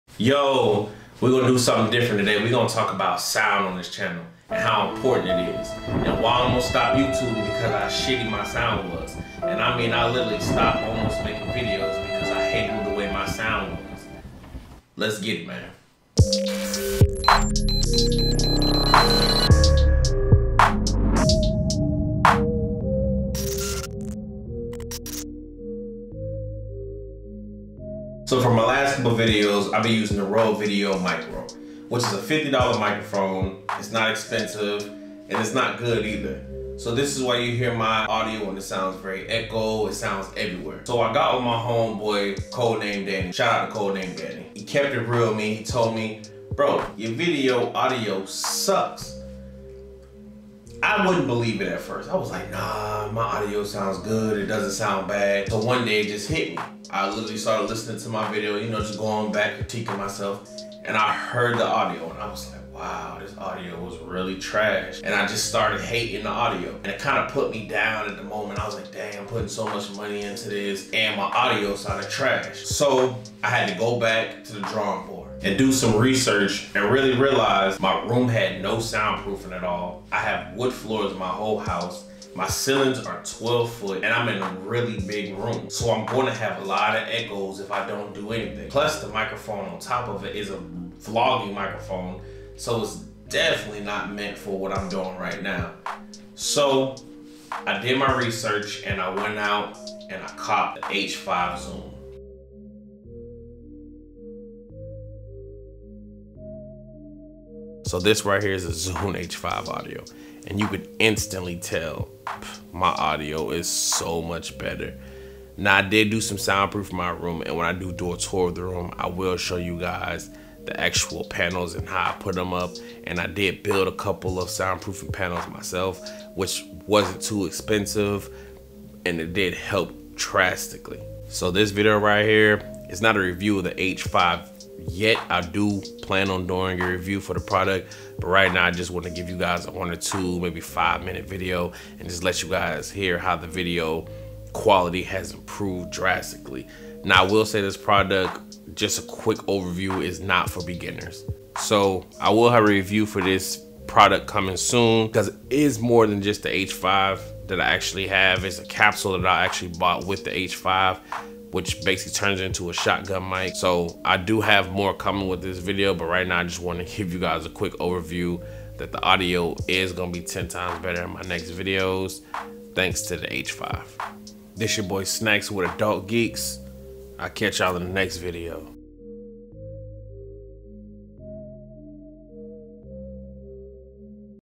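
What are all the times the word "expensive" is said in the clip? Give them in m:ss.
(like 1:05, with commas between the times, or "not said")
0:34, 2:07.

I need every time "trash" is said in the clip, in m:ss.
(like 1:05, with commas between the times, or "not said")
1:04, 1:12.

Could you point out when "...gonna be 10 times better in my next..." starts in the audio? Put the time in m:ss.
2:49.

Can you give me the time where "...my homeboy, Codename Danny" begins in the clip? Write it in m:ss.
0:41.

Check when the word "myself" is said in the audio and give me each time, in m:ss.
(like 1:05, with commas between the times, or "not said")
0:59, 2:05.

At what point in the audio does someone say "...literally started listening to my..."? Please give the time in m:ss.
0:57.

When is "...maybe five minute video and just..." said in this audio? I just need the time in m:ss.
2:20.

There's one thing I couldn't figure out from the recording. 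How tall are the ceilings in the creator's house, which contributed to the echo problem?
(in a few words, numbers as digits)
12 feet.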